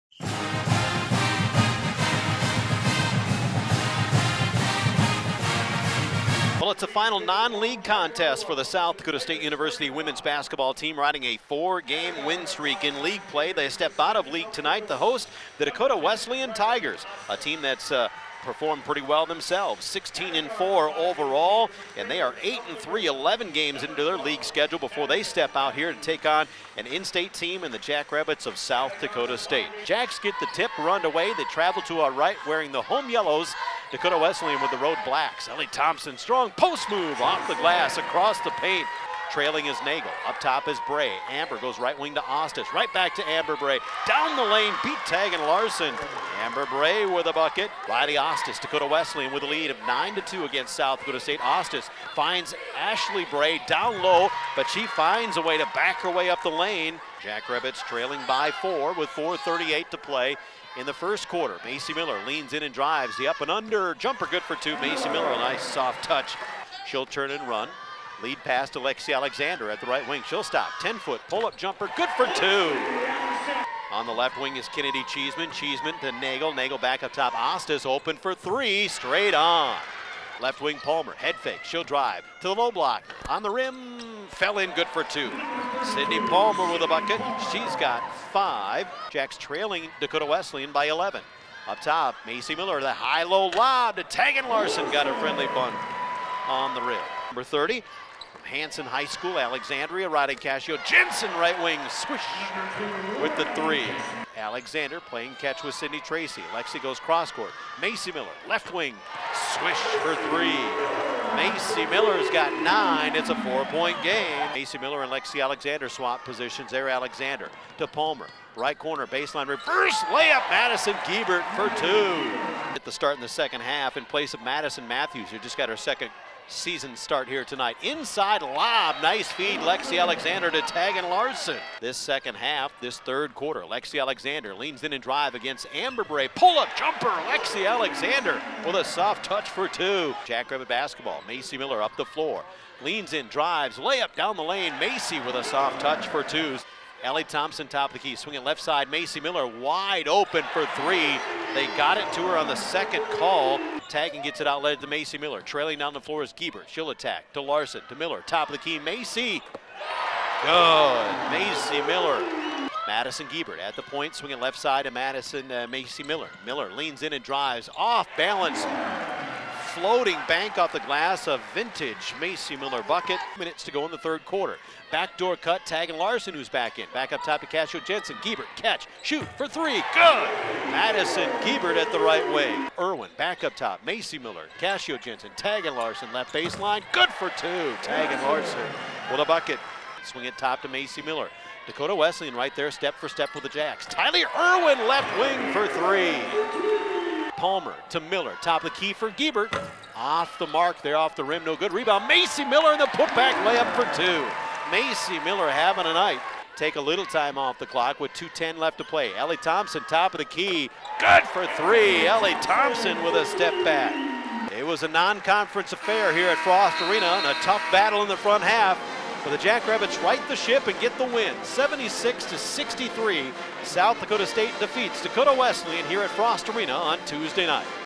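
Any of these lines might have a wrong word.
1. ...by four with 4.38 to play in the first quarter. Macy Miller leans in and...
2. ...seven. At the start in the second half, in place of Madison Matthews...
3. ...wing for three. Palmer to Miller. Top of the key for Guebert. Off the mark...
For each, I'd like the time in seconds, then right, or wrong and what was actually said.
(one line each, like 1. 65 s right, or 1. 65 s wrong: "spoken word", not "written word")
1. 58 s right
2. 121 s wrong: "two", not "seven"
3. 195 s right.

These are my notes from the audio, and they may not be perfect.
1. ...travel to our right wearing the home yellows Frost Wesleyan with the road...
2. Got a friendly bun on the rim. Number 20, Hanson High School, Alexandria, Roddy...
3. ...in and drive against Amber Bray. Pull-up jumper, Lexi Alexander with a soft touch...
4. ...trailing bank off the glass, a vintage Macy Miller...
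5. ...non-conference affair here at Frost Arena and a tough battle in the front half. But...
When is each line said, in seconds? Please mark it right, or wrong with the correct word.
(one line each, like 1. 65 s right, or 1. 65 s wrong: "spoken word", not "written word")
1. 31 s wrong: "Dakota", not "Frost"
2. 94 s wrong: "30", not "20"
3. 134 s right
4. 169 s wrong: "floating", not "trailing"
5. 214 s right.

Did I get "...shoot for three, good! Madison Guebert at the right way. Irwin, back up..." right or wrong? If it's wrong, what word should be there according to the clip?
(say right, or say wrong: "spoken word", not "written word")
right.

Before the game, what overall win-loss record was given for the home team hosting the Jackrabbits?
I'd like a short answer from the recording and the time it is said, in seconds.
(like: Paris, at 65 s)
16-4, at 19 s.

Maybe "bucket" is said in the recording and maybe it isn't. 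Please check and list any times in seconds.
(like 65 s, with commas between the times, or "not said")
47 s, 86 s, 172 s, 189 s.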